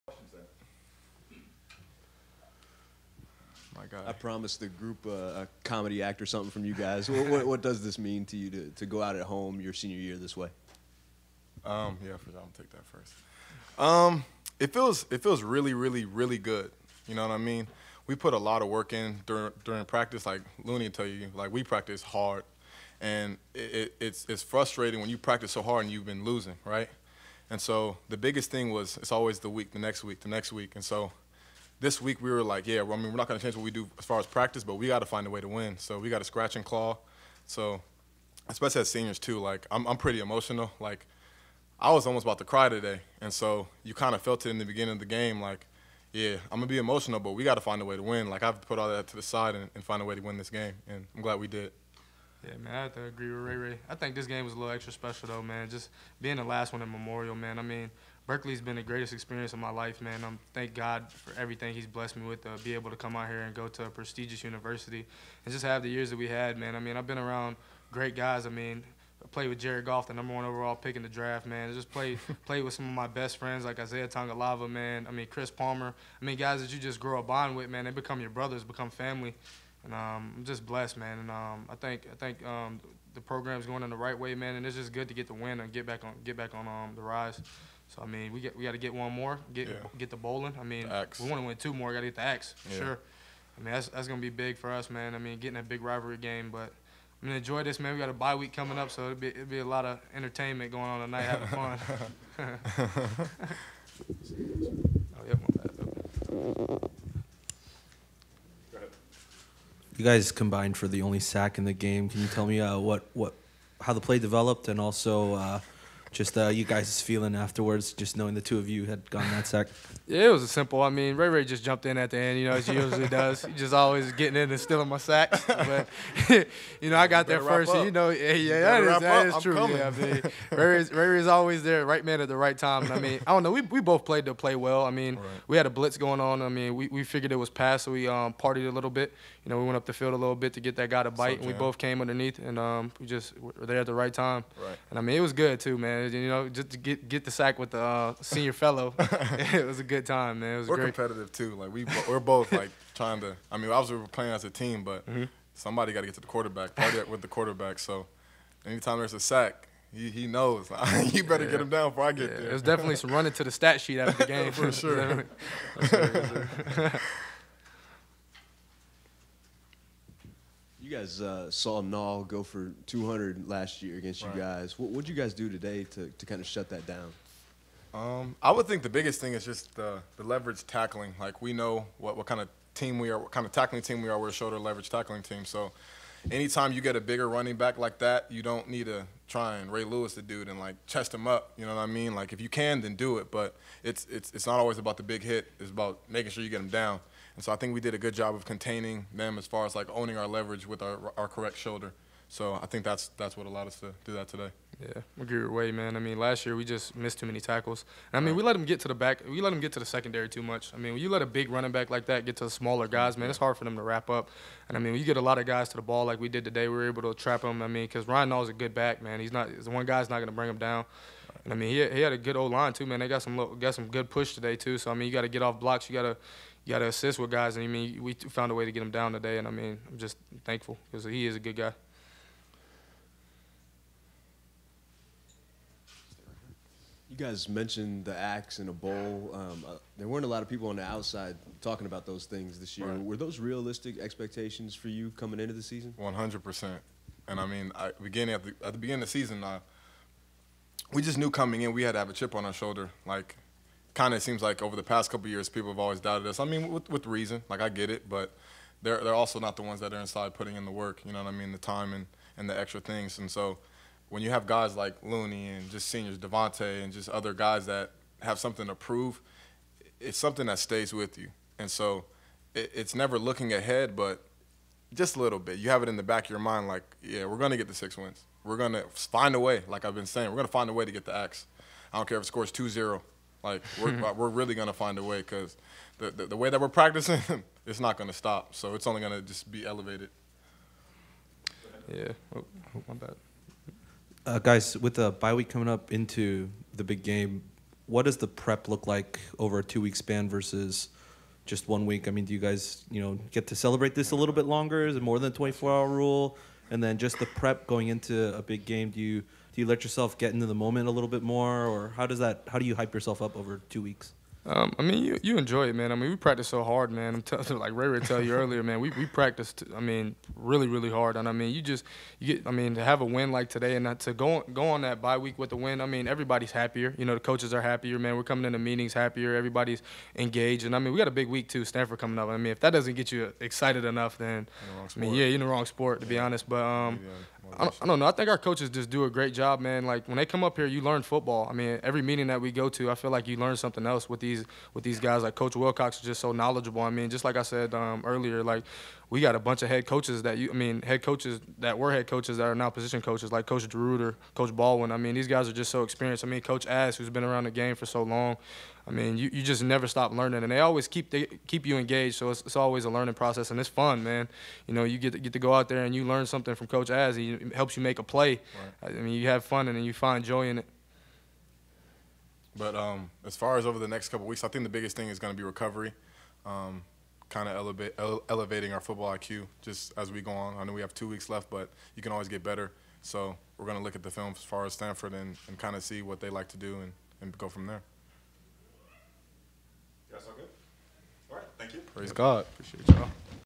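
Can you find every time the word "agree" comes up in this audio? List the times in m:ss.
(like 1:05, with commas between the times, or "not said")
0:53, 3:25.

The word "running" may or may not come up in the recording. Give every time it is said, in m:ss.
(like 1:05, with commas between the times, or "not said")
2:43, 3:07, 3:31.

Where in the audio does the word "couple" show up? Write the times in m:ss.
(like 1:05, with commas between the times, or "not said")
4:15, 6:14.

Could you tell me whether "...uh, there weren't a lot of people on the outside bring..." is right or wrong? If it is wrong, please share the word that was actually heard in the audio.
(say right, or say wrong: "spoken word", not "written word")
wrong: "talking", not "bring".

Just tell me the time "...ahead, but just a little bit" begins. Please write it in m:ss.
4:33.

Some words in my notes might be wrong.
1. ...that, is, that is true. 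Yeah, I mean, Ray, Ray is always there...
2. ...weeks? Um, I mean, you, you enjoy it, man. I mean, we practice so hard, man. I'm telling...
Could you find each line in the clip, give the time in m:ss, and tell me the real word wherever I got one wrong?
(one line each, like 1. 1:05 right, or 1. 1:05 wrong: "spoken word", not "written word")
1. 2:08 right
2. 5:13 right.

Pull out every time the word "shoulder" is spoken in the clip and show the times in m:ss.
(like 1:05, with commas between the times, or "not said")
3:04, 3:21, 4:12.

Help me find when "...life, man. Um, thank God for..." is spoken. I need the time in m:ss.
0:59.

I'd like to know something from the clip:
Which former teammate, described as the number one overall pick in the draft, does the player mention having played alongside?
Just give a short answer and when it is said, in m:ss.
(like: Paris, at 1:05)
Jared Goff, at 1:09.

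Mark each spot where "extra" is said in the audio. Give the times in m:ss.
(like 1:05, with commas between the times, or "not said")
0:54, 4:22.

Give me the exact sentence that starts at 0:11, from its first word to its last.
Um, yeah, am gonna take that first.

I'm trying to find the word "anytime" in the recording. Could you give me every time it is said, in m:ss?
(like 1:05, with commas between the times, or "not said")
2:38, 3:06.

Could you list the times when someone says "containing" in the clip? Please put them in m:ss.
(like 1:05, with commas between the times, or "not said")
3:18.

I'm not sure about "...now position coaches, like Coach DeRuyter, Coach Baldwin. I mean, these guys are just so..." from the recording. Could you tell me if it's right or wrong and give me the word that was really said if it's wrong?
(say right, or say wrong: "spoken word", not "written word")
right.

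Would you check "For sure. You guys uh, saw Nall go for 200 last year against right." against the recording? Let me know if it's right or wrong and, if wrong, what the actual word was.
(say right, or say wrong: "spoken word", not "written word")
right.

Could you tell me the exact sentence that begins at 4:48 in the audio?
So it's only gonna just be elevated.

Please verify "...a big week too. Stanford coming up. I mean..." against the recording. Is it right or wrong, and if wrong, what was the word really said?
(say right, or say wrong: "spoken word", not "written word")
right.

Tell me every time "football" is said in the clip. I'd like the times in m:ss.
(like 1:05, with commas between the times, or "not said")
5:41, 6:18.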